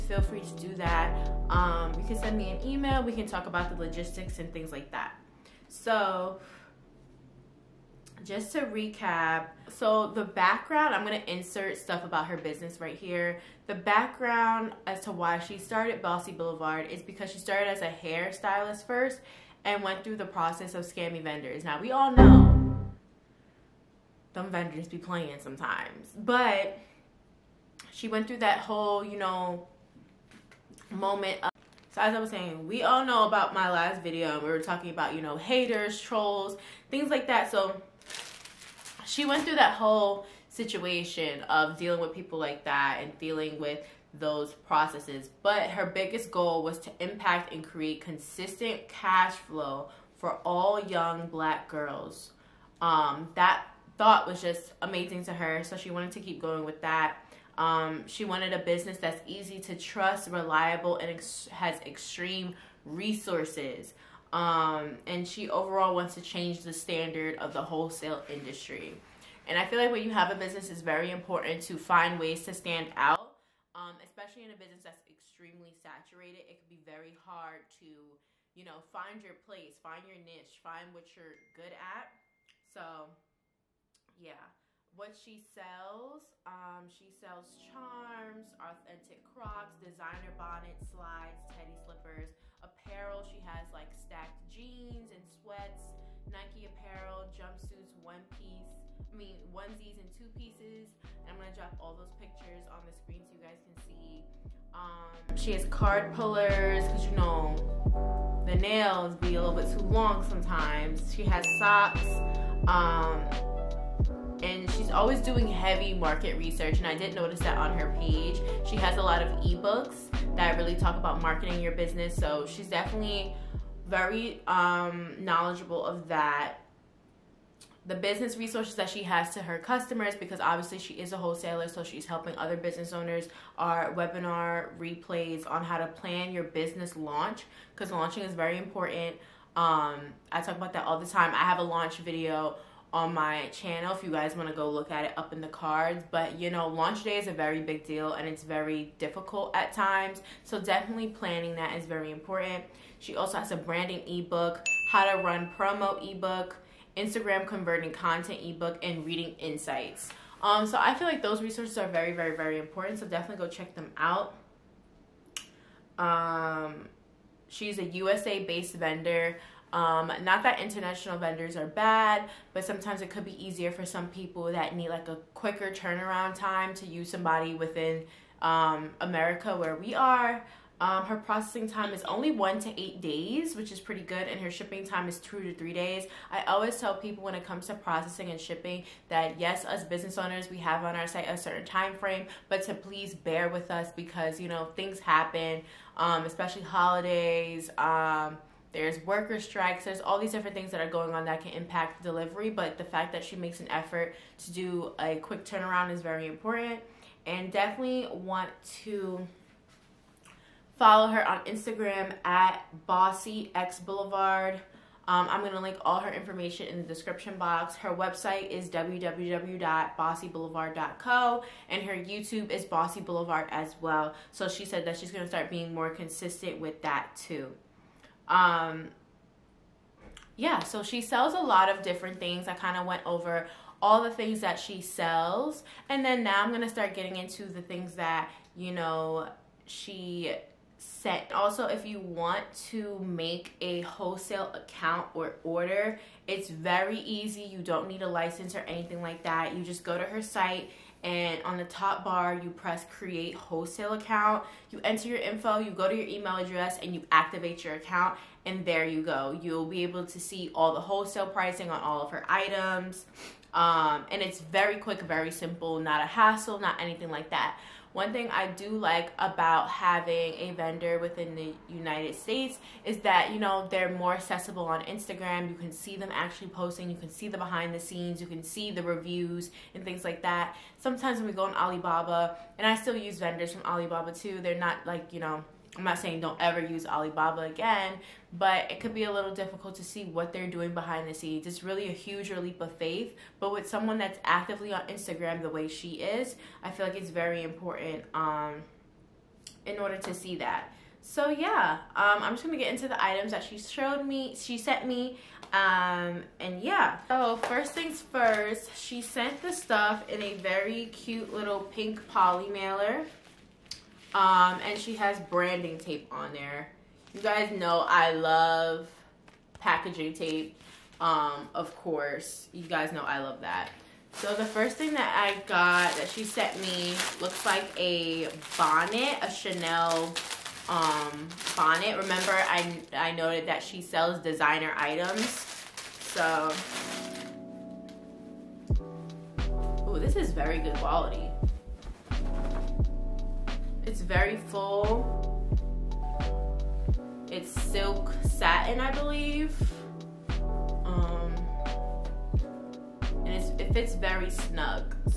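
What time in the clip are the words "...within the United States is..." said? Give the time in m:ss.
4:30.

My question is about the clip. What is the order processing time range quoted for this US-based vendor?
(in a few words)
1 to 8 days.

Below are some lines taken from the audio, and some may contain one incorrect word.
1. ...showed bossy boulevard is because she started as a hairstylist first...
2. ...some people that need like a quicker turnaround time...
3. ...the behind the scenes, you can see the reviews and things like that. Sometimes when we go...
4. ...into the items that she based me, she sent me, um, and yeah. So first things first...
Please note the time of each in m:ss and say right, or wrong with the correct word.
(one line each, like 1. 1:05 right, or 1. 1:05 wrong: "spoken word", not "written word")
1. 0:15 wrong: "started", not "showed"
2. 2:53 right
3. 4:37 right
4. 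5:02 wrong: "showed", not "based".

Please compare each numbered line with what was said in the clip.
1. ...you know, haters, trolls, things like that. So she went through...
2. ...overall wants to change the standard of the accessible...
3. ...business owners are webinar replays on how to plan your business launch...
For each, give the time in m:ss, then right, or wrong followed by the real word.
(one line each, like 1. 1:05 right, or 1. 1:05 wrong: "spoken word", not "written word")
1. 0:35 right
2. 1:05 wrong: "wholesale", not "accessible"
3. 2:12 right.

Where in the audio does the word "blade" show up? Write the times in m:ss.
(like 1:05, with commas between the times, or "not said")
not said.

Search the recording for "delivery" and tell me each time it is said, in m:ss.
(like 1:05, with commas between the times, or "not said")
3:22.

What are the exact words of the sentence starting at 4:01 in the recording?
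Also, if you want to make a wholesale account or order, it's very easy.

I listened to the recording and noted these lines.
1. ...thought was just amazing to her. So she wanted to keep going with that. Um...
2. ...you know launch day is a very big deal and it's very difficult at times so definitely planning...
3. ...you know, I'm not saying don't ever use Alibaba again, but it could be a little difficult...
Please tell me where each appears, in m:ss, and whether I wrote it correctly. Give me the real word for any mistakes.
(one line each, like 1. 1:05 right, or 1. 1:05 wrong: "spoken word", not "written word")
1. 0:53 right
2. 2:26 right
3. 4:45 right.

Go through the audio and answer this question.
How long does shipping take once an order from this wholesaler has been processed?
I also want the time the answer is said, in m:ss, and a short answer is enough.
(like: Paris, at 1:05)
2 to 3 days, at 3:05.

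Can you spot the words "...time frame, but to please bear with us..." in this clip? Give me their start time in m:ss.
3:11.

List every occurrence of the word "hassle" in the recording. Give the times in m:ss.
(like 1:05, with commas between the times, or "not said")
4:26.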